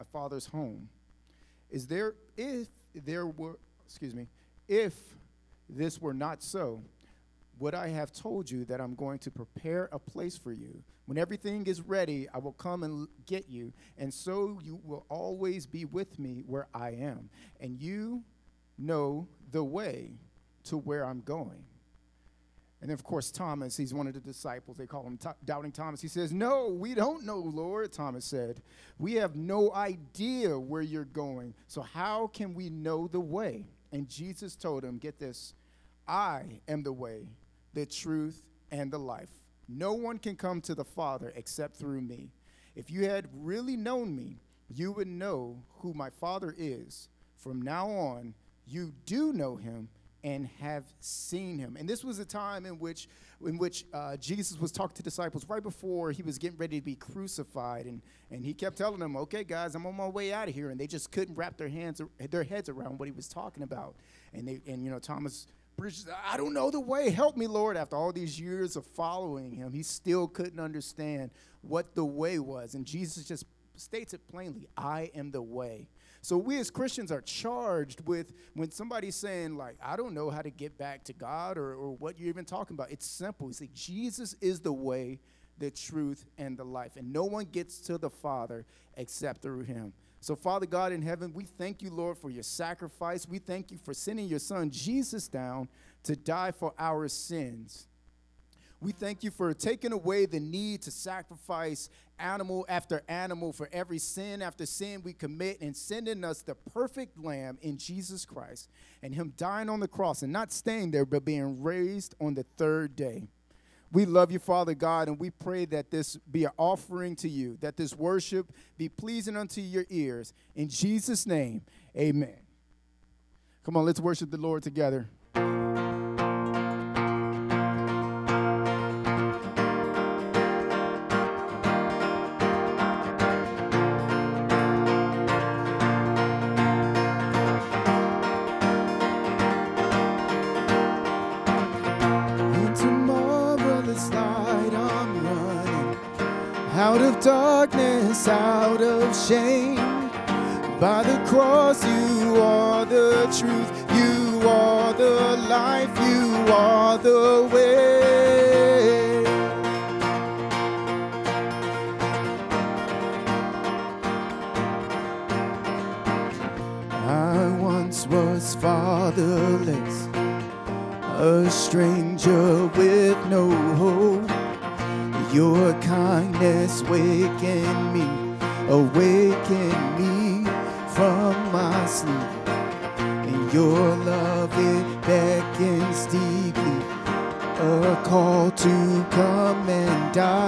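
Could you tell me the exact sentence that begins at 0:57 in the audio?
And, and he kept telling them, okay, guys, I'm on my way out of here.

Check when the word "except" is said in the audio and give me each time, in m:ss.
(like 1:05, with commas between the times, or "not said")
0:41, 1:28.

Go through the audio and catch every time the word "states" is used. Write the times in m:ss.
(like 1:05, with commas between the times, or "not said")
1:13.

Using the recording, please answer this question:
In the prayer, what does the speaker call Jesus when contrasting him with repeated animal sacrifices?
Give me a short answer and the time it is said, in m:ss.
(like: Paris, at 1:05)
the perfect lamb, at 1:46.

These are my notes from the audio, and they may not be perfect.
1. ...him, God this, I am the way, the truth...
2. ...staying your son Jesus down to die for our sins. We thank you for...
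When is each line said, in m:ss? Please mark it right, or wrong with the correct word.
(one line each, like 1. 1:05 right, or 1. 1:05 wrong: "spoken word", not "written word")
1. 0:34 wrong: "Get", not "God"
2. 1:33 wrong: "sending", not "staying".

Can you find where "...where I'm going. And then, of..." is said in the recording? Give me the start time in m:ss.
0:20.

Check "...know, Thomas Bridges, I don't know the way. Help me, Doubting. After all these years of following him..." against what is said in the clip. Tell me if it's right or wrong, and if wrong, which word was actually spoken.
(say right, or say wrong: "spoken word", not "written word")
wrong: "Lord", not "Doubting".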